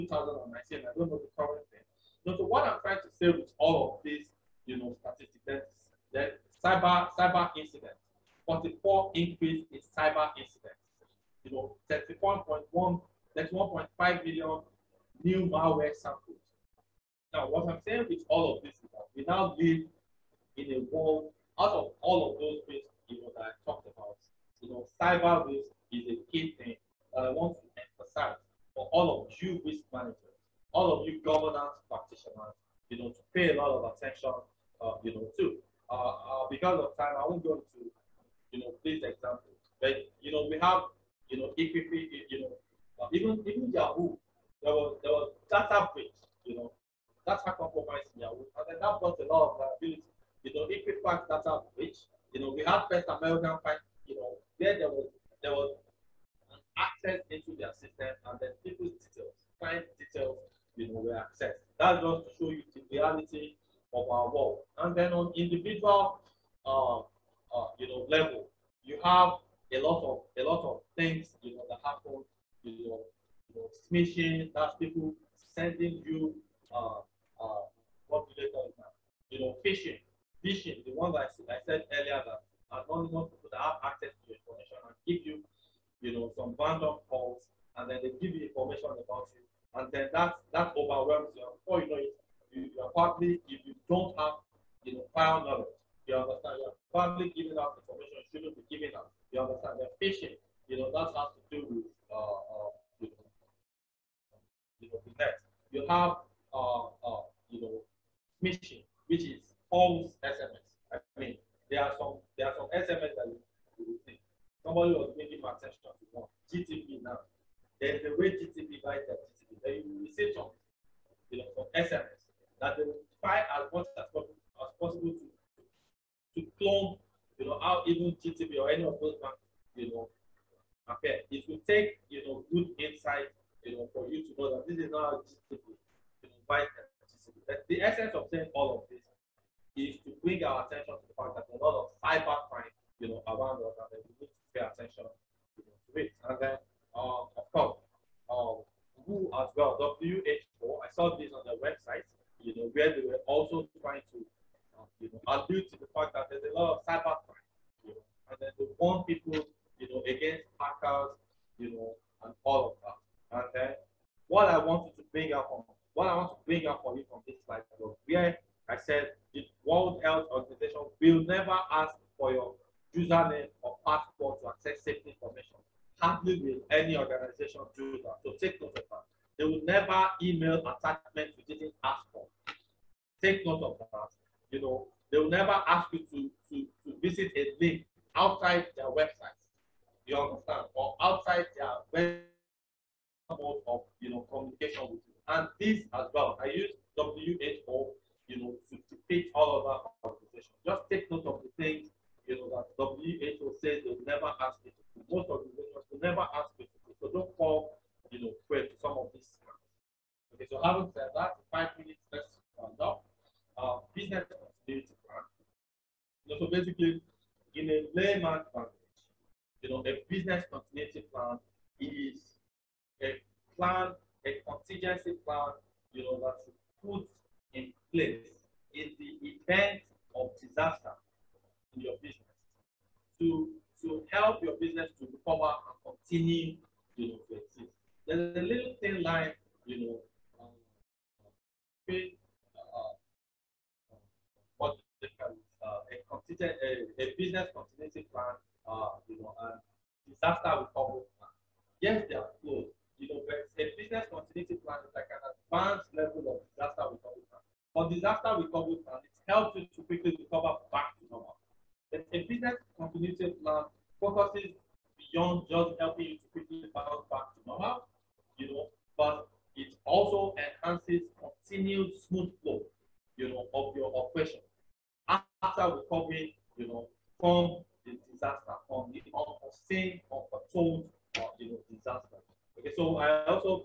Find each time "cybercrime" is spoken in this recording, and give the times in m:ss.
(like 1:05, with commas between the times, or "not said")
2:22, 2:36.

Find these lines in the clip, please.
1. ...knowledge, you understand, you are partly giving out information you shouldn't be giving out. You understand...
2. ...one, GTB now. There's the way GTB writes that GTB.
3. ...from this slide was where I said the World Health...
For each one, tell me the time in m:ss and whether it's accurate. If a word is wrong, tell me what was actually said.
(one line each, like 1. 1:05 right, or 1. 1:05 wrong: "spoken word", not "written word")
1. 1:35 right
2. 1:56 right
3. 2:47 right.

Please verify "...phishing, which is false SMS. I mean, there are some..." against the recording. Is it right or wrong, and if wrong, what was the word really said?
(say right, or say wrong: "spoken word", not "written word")
right.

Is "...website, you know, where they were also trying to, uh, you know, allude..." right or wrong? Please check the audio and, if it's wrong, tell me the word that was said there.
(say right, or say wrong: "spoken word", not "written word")
right.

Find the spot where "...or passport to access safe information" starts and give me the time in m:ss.
2:53.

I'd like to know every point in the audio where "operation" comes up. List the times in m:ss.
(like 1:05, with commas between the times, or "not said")
4:33.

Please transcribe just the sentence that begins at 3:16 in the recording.
I use WHO, you know, to depict all of our organizations.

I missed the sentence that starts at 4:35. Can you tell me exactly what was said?
After recovery, you know, from the disaster, from the unforeseen, unforetold, or, uh, you know, disaster.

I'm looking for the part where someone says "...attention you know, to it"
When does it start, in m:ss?
2:24.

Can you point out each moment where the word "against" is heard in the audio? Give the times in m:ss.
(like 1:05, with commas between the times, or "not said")
2:40.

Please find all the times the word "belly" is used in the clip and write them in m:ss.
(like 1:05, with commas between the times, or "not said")
not said.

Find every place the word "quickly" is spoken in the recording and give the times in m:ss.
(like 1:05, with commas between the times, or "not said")
4:19, 4:26.